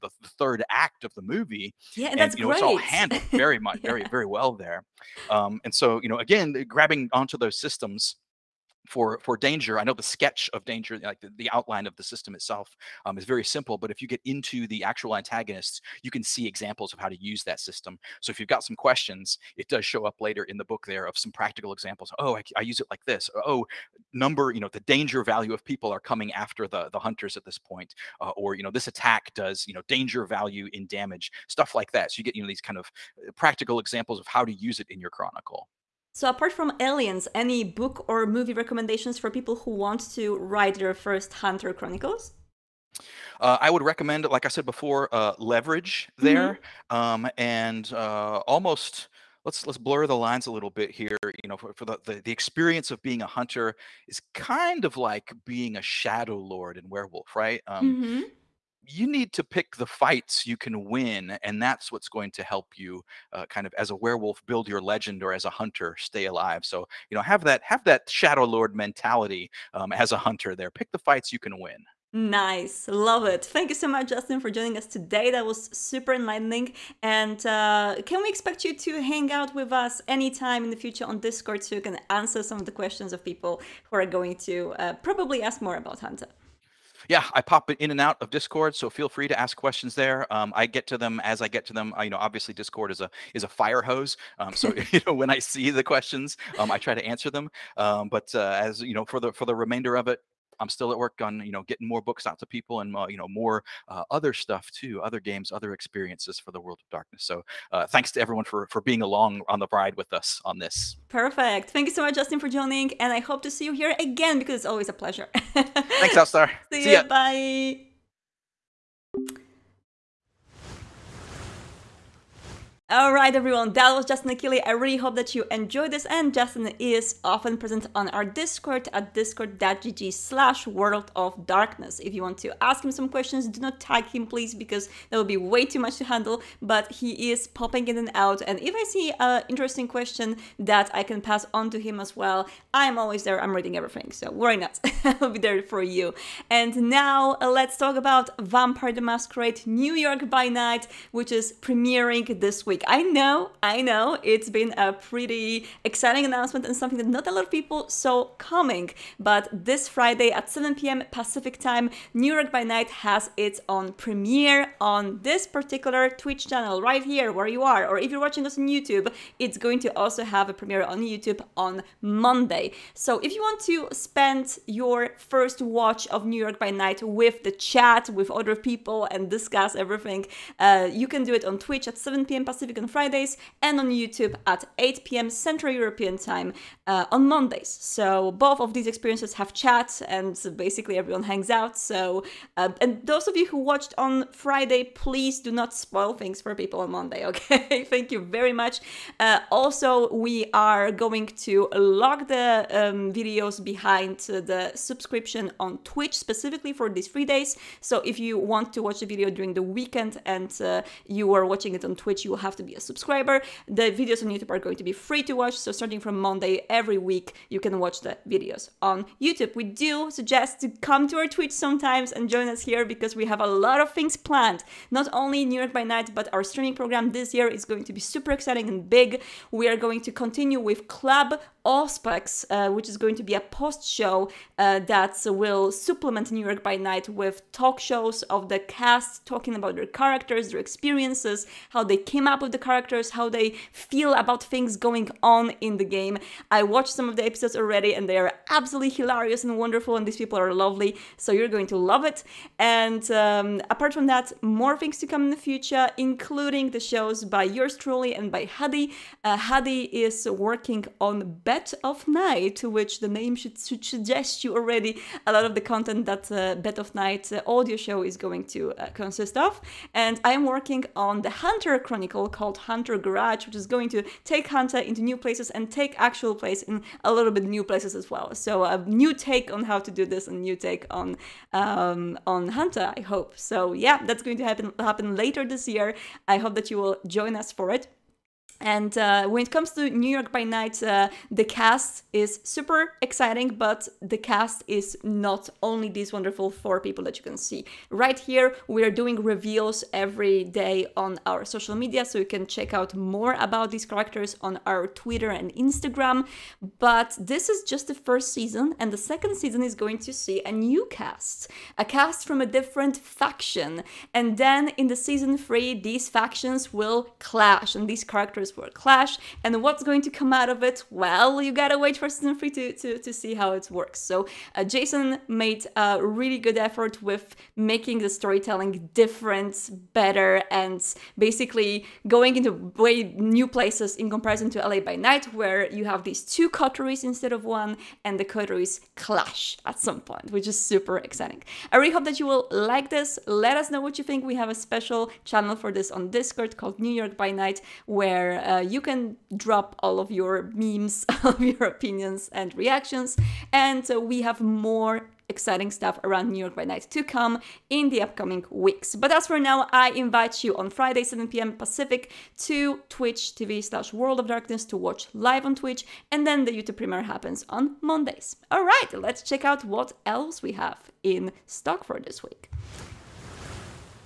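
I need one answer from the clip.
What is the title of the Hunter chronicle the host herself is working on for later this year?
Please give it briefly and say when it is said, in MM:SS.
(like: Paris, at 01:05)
Hunter Garage, at 04:32.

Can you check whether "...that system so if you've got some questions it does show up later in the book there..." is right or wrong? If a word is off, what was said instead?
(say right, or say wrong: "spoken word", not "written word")
right.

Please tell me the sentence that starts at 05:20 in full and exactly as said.
Well, you gotta wait for season three to, to, to see how it works.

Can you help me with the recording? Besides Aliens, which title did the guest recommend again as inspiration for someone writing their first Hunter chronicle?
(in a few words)
Leverage.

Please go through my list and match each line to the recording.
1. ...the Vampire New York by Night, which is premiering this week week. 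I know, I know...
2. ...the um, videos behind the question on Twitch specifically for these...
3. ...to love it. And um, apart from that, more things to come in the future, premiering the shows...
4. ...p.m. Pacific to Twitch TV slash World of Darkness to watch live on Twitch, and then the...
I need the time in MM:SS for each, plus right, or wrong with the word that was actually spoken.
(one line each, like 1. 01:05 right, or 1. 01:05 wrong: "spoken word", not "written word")
1. 02:28 wrong: "Masquerade", not "Vampire"
2. 03:22 wrong: "subscription", not "question"
3. 04:11 wrong: "including", not "premiering"
4. 06:01 right.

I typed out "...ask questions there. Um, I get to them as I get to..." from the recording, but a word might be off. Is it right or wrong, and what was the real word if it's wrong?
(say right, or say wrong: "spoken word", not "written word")
right.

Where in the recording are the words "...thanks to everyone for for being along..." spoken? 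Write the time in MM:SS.
01:47.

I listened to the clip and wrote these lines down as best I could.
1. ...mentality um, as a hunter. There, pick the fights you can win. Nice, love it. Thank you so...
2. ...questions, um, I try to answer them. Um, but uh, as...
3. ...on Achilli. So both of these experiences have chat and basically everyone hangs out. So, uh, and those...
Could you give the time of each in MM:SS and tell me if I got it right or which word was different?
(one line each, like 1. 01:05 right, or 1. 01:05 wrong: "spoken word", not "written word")
1. 01:08 right
2. 01:35 right
3. 03:07 wrong: "Mondays", not "Achilli".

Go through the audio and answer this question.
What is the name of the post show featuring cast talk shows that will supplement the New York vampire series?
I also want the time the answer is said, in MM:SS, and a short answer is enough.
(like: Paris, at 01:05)
Club Auspex, at 03:50.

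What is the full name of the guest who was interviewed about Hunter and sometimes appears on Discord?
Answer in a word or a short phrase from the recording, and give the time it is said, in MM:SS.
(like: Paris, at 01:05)
Justin Achilli, at 02:04.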